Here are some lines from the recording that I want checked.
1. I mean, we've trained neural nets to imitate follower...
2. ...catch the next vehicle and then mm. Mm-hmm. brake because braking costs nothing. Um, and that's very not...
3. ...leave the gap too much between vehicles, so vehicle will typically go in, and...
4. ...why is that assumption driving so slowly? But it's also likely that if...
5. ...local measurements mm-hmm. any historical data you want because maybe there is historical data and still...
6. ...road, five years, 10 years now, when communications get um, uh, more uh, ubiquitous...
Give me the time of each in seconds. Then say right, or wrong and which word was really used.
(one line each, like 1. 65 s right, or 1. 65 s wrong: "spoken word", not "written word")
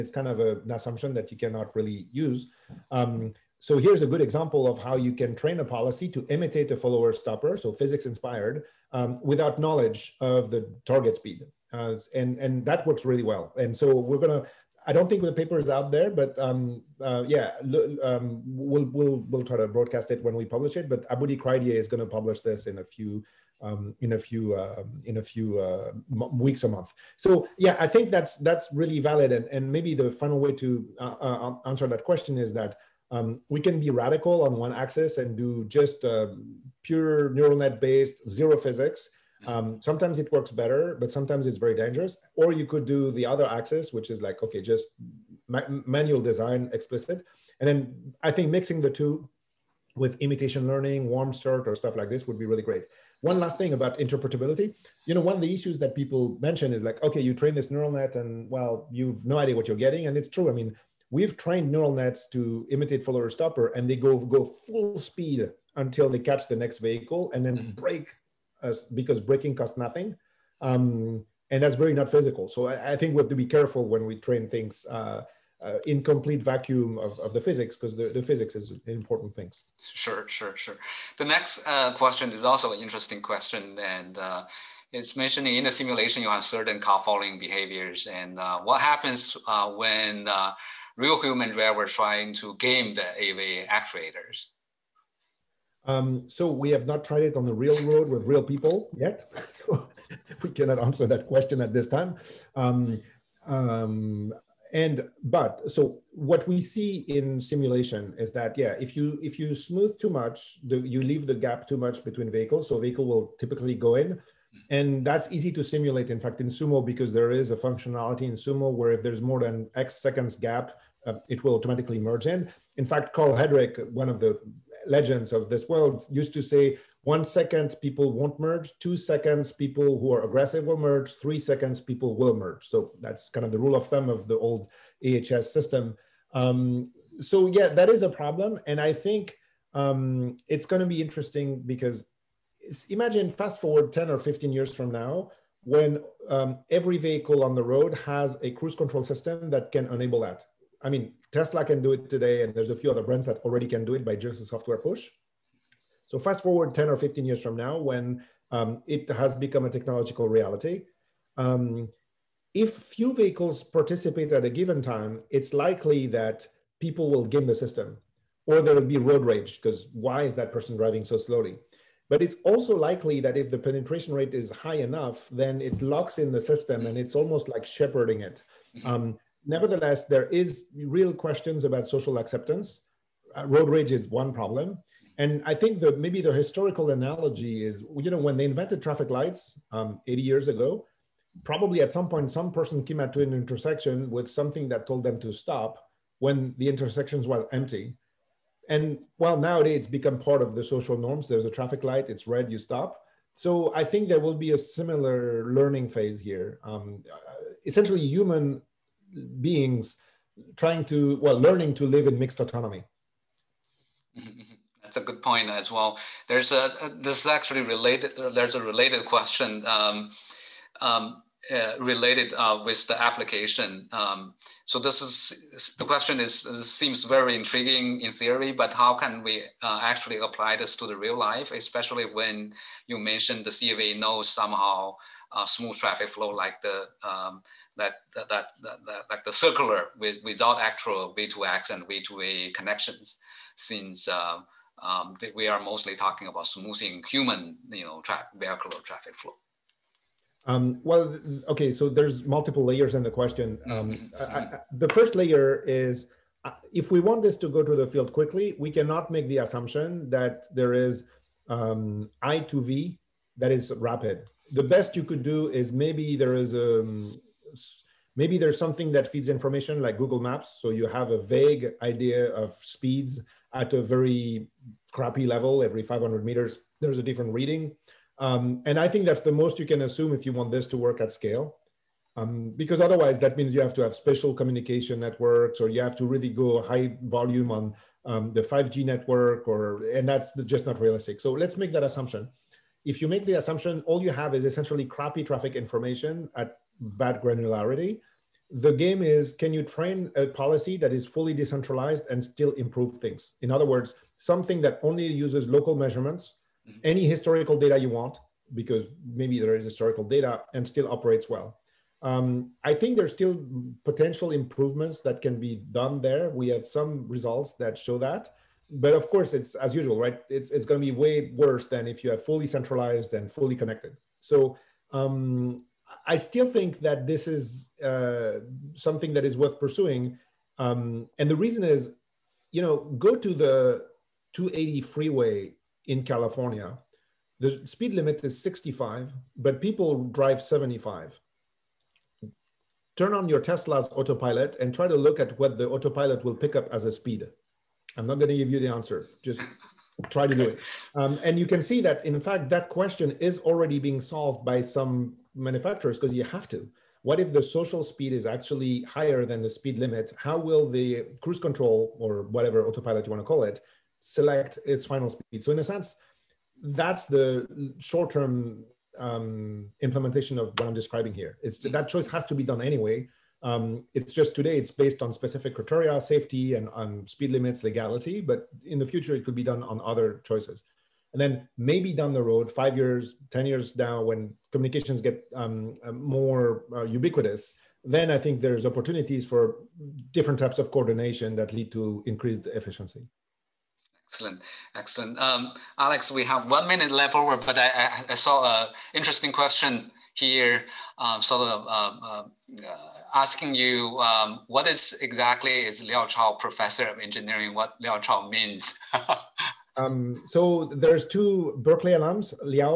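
1. 60 s right
2. 66 s right
3. 111 s right
4. 169 s wrong: "person", not "assumption"
5. 305 s right
6. 382 s right.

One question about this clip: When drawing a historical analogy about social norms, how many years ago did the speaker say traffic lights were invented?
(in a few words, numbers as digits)
80 years.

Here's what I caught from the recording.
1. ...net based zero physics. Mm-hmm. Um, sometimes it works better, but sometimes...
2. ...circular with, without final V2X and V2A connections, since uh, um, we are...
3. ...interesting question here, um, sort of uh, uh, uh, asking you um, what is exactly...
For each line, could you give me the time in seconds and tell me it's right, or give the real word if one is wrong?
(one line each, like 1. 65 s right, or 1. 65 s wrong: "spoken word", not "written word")
1. 37 s right
2. 239 s wrong: "actual", not "final"
3. 398 s right.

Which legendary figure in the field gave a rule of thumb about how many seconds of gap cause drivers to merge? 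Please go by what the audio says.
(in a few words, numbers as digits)
Karl Hedrick.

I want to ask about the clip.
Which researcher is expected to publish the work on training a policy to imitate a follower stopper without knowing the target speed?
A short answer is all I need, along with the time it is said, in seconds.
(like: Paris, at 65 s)
Aboudy Kreidieh, at 21 s.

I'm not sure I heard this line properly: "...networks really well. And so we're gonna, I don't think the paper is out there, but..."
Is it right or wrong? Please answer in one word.
wrong.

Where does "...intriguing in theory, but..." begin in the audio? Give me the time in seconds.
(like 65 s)
227 s.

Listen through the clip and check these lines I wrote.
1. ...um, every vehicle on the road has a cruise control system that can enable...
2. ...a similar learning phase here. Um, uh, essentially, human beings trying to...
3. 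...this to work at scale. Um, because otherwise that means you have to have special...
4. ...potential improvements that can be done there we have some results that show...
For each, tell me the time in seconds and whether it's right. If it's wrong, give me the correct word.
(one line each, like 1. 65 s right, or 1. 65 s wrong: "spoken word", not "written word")
1. 146 s right
2. 204 s right
3. 280 s right
4. 313 s right.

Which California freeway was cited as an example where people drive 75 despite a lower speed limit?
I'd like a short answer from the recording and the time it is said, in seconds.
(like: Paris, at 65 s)
280, at 334 s.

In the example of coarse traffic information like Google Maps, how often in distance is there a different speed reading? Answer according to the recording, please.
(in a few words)
Every 500 meters.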